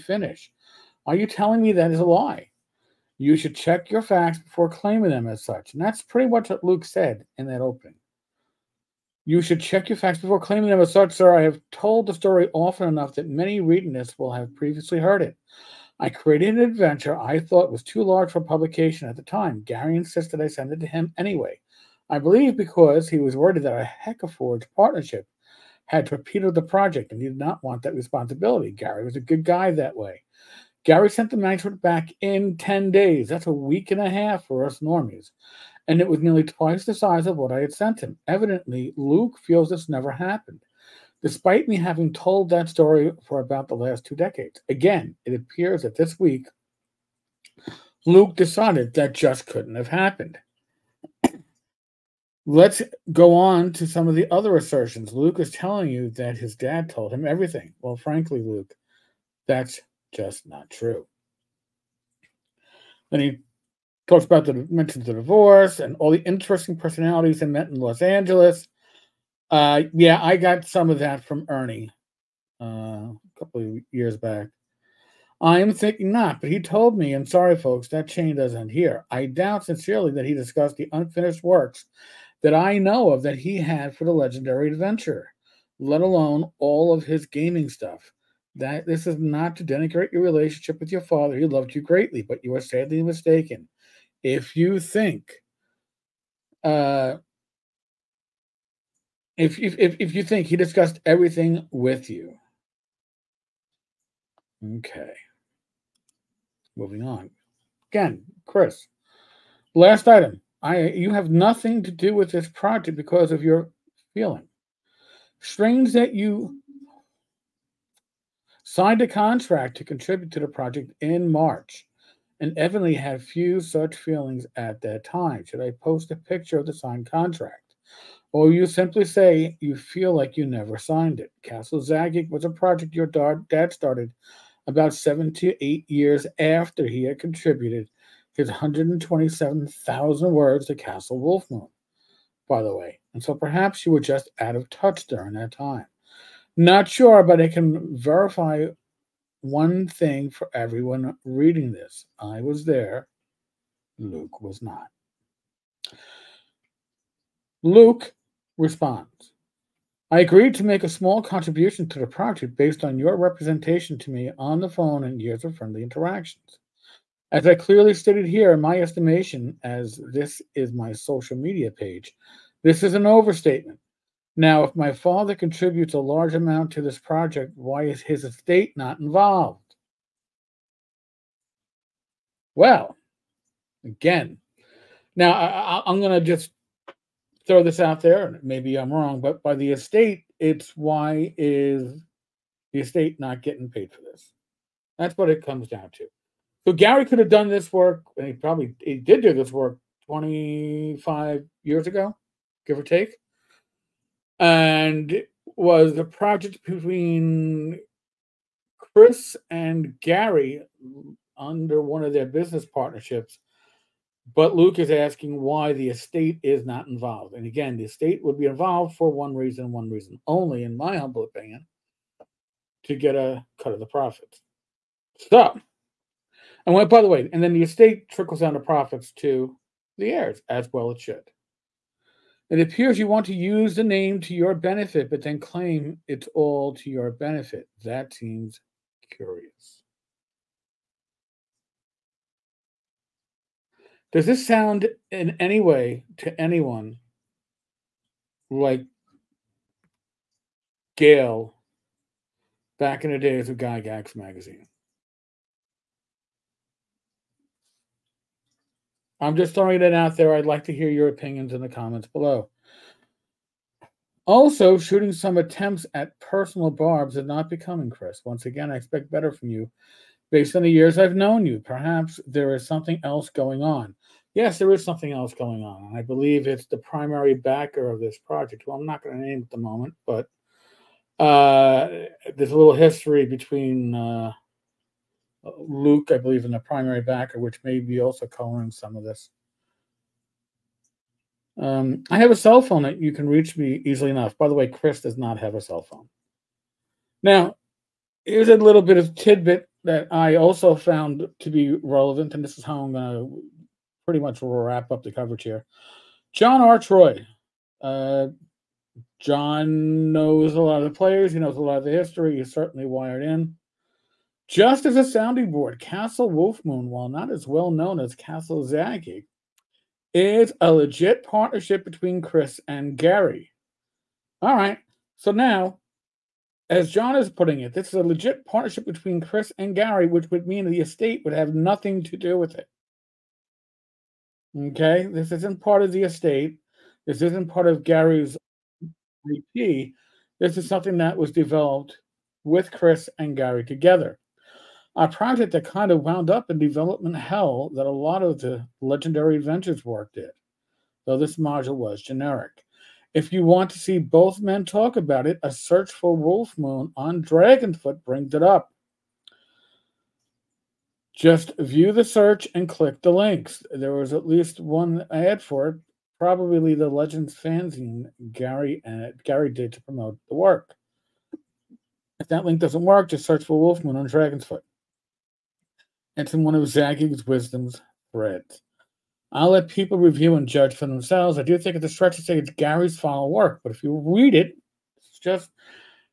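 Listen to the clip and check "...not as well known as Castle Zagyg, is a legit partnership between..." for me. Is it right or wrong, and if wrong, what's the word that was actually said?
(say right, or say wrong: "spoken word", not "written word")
right.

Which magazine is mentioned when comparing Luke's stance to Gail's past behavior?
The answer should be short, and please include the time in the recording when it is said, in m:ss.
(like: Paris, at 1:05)
Gygax magazine, at 4:13.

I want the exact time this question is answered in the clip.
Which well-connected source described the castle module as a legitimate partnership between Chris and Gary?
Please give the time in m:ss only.
5:06.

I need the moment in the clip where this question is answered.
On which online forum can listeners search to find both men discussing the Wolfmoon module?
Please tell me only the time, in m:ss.
5:57.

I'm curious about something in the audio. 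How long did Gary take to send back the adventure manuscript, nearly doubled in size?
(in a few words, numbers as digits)
10 days.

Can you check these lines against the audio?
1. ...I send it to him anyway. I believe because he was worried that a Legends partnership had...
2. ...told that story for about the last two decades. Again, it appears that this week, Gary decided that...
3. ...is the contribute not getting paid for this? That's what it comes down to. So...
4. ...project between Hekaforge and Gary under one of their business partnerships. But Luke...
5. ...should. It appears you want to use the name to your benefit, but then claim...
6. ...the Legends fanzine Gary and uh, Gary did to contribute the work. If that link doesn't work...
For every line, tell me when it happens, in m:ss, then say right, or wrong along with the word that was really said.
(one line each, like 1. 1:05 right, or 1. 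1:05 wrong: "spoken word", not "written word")
1. 0:20 wrong: "Hekaforge", not "Legends"
2. 0:42 wrong: "Luke", not "Gary"
3. 3:11 wrong: "estate", not "contribute"
4. 3:26 wrong: "Chris", not "Hekaforge"
5. 3:51 right
6. 6:06 wrong: "promote", not "contribute".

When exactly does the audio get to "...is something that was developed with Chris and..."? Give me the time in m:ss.
5:40.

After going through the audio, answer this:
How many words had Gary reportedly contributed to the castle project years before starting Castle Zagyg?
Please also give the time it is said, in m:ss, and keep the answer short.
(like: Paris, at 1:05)
127,000, at 2:18.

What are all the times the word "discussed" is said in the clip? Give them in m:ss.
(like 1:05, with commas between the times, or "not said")
1:20, 1:40.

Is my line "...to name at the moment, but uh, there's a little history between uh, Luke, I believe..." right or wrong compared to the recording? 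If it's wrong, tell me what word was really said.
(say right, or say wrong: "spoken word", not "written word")
right.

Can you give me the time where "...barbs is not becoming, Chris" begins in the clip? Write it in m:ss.
4:26.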